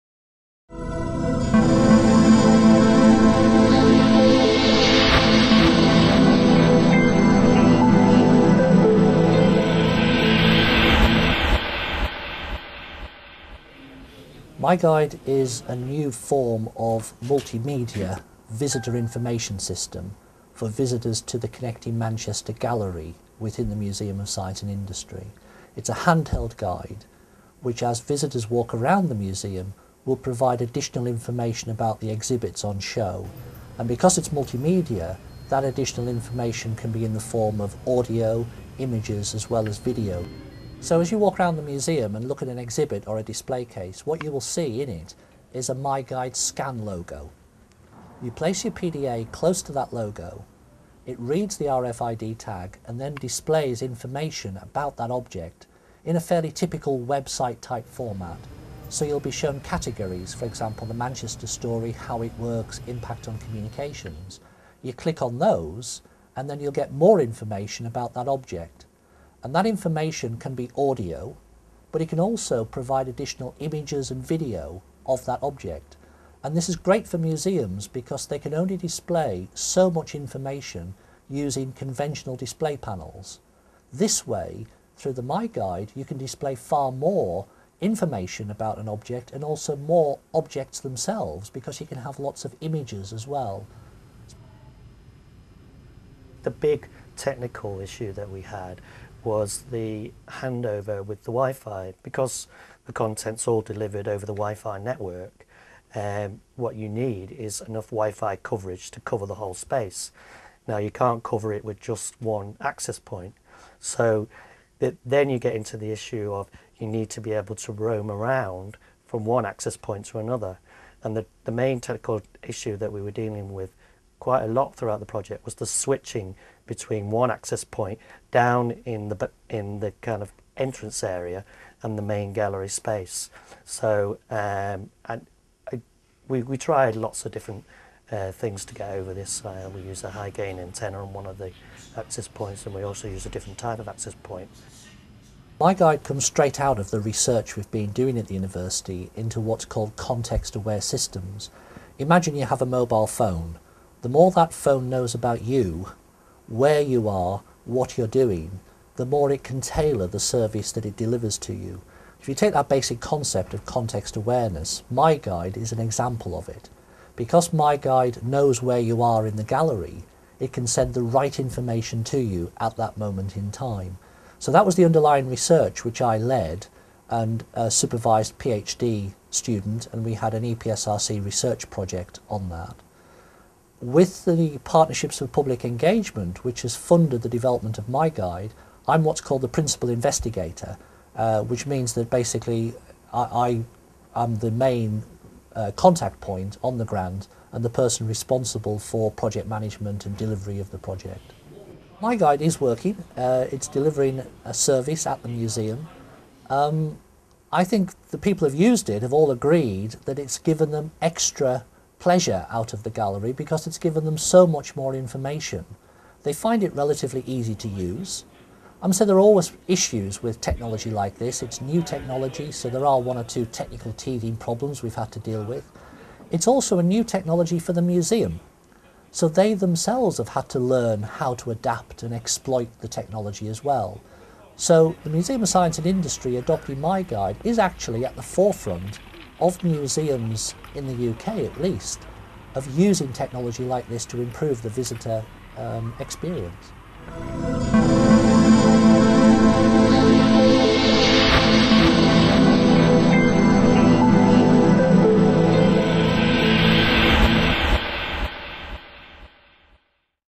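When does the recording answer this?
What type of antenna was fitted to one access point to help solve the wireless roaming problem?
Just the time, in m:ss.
2:20.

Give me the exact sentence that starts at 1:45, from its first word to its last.
Um, what you need is enough Wi-Fi coverage to cover the whole space.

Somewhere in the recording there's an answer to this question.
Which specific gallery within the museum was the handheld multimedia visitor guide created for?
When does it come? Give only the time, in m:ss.
0:21.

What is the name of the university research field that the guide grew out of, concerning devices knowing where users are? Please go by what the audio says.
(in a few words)
context aware systems.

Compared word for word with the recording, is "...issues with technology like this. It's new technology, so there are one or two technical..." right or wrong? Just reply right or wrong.
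right.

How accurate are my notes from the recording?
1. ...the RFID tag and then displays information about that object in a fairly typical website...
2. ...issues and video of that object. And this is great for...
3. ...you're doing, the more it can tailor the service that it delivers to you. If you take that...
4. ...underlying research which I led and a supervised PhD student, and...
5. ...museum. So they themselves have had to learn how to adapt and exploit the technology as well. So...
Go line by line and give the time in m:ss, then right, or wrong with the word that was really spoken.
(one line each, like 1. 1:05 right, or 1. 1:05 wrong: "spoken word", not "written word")
1. 0:51 right
2. 1:13 wrong: "images", not "issues"
3. 2:37 right
4. 2:54 right
5. 3:47 right.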